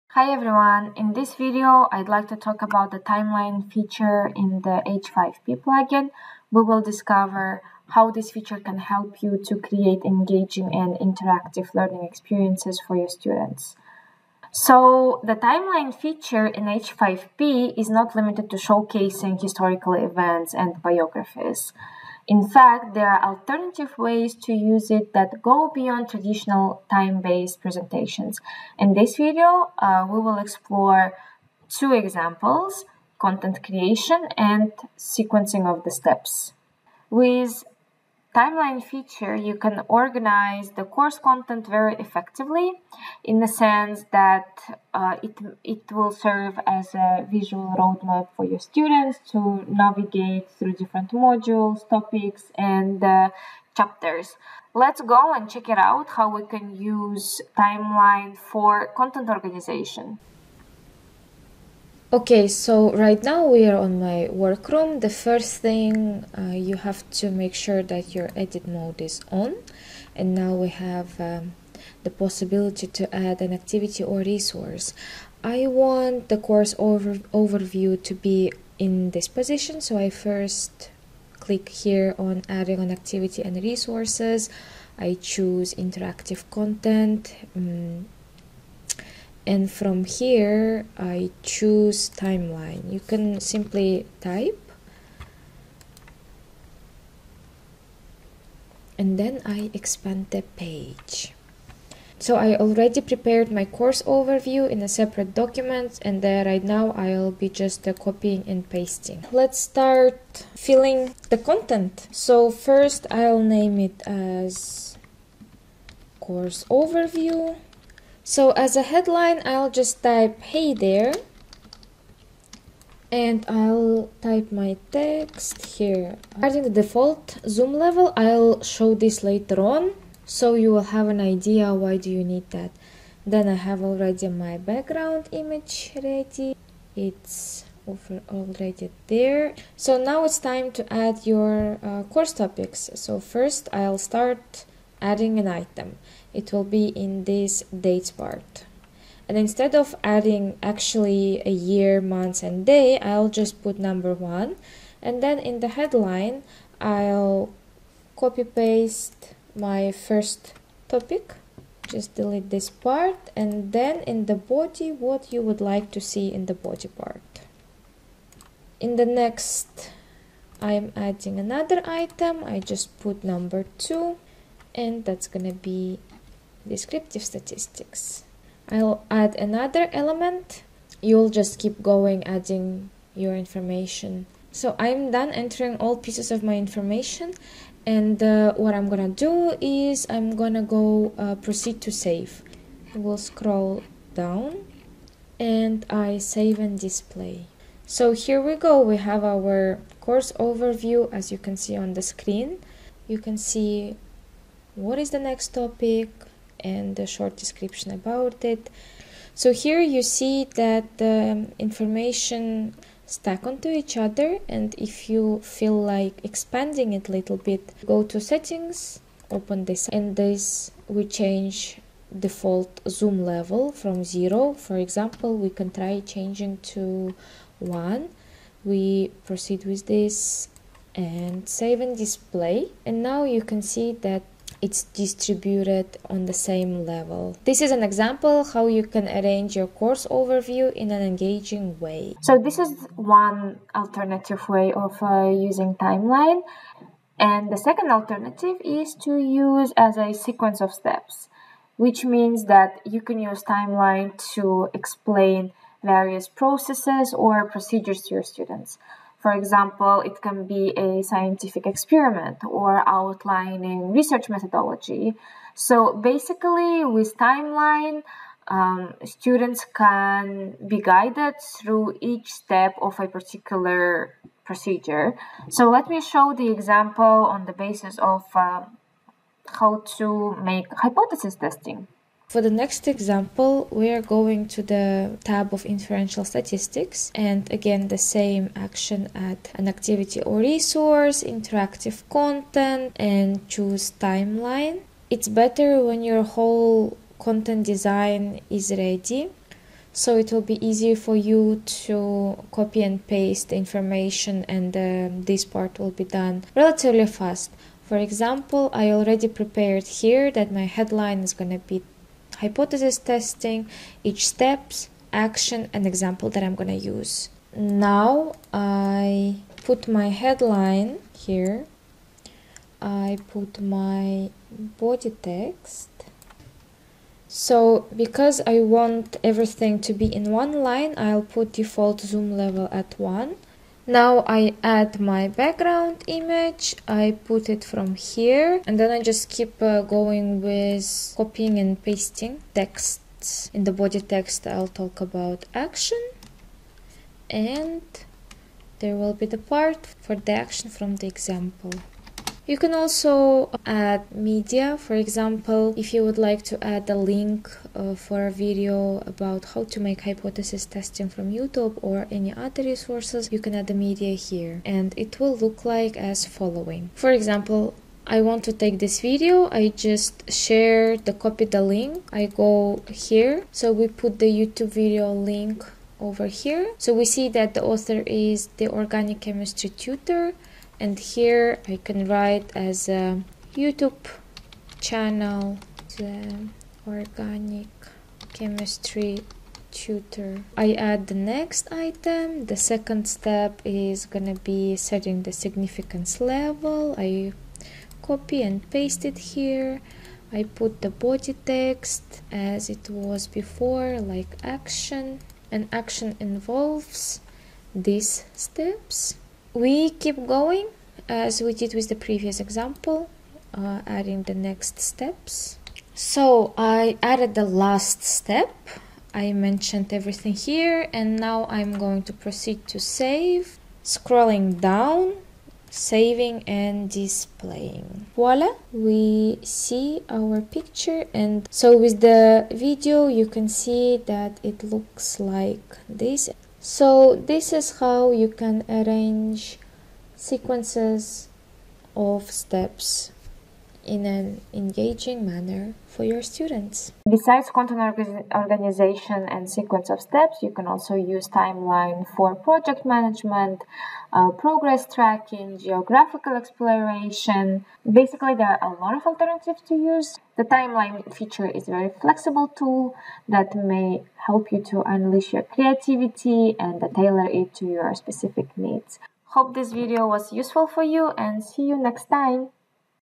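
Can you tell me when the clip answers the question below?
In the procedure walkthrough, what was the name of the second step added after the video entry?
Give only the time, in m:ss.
6:34.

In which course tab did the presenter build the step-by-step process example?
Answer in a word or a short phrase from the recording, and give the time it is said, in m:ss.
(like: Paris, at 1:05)
Inferential statistics, at 4:45.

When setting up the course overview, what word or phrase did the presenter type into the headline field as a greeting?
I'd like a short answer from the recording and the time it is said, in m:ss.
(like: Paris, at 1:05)
hey there, at 2:00.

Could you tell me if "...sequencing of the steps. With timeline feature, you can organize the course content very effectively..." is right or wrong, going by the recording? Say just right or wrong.
right.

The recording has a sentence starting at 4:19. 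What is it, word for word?
For example, it can be a scientific experiment or outlining research methodology.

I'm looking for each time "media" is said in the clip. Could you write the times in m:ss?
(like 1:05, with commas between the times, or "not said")
5:54, 6:03.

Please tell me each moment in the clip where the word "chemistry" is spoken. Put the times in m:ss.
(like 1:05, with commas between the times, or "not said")
6:19, 6:28.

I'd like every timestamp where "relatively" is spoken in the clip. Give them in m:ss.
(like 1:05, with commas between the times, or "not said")
5:06.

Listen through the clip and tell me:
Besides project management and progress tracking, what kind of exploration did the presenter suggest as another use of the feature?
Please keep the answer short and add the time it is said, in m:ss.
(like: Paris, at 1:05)
Geographical exploration, at 7:35.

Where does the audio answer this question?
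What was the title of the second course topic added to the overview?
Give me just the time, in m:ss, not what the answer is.
2:56.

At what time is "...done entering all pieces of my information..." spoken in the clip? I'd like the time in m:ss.
3:05.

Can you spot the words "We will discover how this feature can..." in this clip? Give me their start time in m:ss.
0:06.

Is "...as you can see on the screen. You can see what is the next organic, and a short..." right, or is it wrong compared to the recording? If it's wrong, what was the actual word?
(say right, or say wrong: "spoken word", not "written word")
wrong: "topic", not "organic".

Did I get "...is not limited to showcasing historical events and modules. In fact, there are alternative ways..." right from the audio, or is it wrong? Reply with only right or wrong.
wrong.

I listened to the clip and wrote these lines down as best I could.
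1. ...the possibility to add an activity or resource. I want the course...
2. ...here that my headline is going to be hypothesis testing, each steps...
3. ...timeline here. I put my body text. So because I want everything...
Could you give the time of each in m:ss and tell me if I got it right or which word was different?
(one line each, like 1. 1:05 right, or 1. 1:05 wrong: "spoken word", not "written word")
1. 1:12 right
2. 5:09 right
3. 5:20 wrong: "headline", not "timeline".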